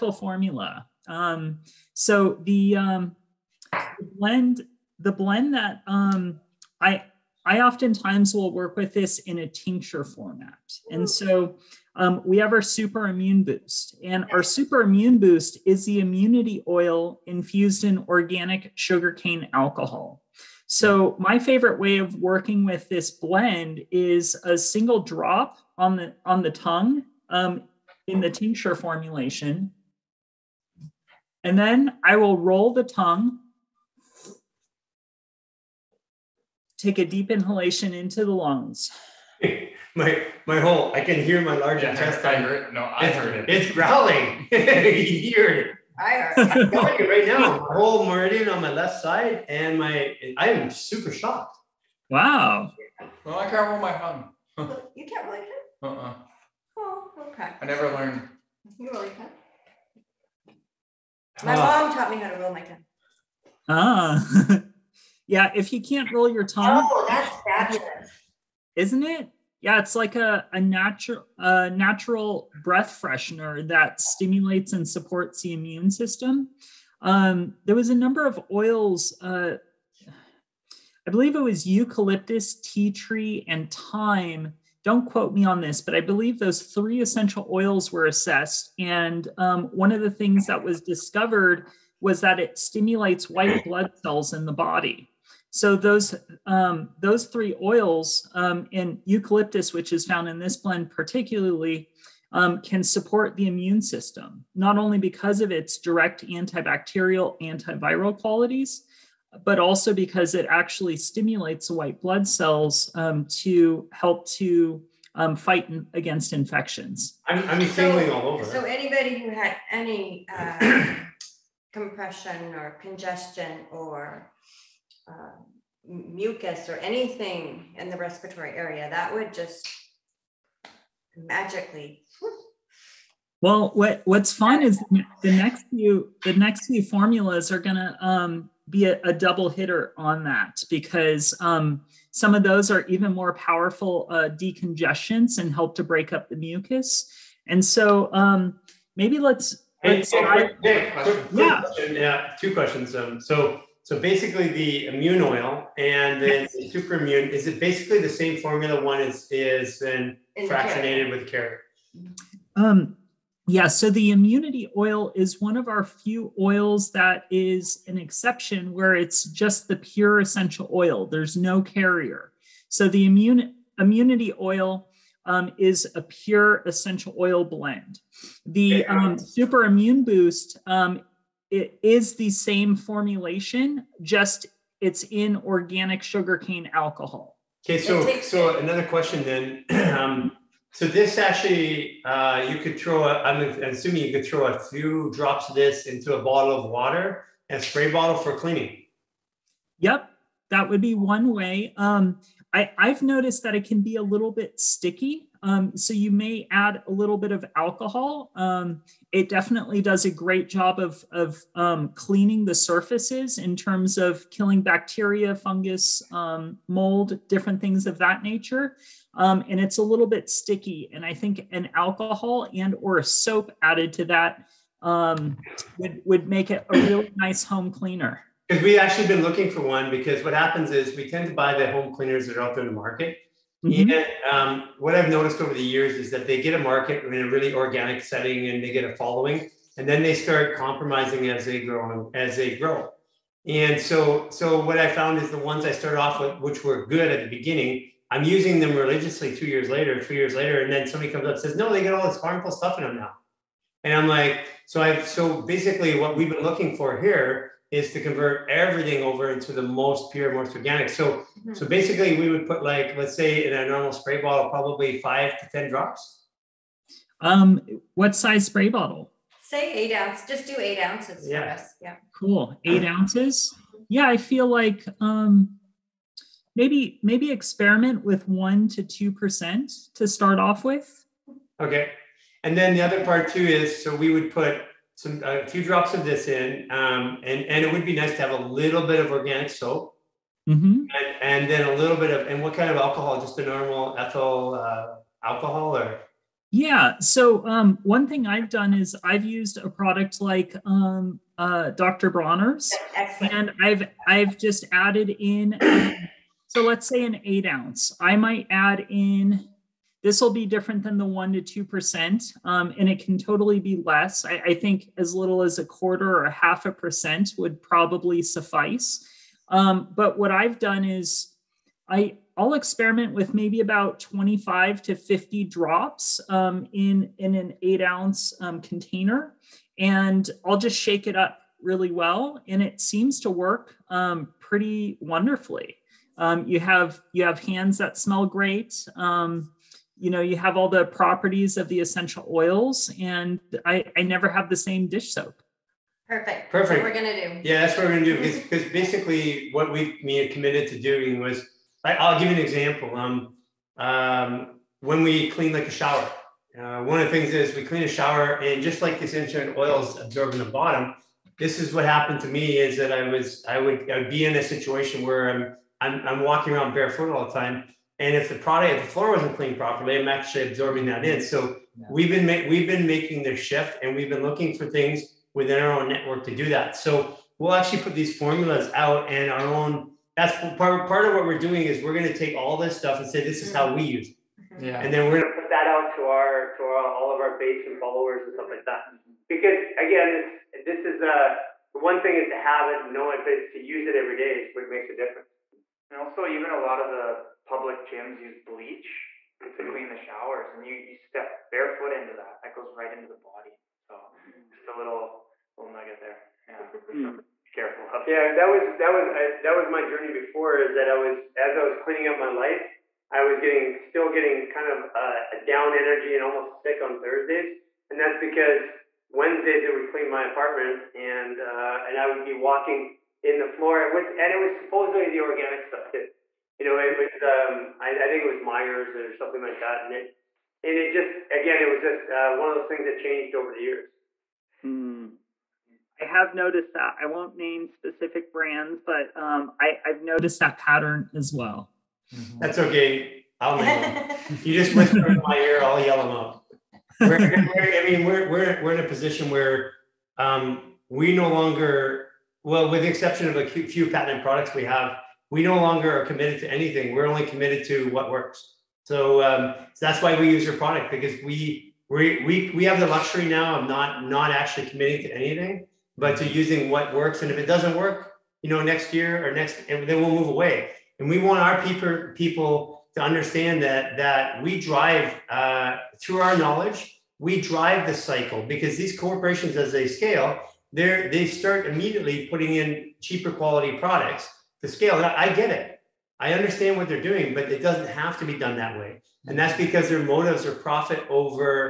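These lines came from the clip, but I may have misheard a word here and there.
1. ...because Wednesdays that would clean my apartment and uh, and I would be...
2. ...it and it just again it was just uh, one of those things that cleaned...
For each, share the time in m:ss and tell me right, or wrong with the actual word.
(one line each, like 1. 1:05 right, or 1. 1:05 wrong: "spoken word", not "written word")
1. 6:58 right
2. 7:09 wrong: "changed", not "cleaned".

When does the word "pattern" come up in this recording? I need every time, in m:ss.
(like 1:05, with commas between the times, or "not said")
7:20.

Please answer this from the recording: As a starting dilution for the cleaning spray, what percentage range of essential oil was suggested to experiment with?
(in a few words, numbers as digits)
1 to 2%.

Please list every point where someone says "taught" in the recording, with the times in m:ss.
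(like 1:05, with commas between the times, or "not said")
1:01.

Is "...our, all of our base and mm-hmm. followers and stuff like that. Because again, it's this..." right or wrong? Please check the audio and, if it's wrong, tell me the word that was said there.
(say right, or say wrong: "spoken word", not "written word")
right.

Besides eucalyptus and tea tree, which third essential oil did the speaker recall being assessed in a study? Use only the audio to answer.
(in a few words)
thyme.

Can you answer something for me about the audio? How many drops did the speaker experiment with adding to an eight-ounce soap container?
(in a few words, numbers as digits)
25 to 50 drops.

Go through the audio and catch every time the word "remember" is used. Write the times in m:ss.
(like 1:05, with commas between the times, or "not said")
not said.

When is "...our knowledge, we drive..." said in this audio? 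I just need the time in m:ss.
7:56.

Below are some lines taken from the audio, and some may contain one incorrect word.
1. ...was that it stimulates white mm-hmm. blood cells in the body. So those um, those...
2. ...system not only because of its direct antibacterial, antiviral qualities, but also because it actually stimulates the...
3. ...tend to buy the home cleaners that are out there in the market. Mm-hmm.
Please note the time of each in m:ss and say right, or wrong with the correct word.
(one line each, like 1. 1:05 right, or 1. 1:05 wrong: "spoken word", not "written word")
1. 1:31 right
2. 1:43 right
3. 3:51 right.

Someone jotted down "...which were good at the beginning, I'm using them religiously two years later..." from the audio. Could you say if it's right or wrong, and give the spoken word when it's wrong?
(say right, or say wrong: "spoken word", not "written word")
right.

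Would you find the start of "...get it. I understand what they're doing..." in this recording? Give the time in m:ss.
8:05.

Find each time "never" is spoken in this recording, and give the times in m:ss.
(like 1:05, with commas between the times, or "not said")
0:57, 5:44.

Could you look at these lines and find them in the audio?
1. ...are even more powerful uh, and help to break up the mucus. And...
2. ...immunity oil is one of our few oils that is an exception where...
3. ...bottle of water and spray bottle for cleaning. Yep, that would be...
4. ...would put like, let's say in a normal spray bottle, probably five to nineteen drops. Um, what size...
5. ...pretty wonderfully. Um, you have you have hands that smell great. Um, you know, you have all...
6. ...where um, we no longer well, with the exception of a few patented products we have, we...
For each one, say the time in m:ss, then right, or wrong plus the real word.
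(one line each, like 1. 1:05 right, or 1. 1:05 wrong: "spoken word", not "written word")
1. 2:22 right
2. 2:44 right
3. 3:16 right
4. 4:22 wrong: "ten", not "nineteen"
5. 5:34 right
6. 7:29 right.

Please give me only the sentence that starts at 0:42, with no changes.
I heard, no, I it's, heard it.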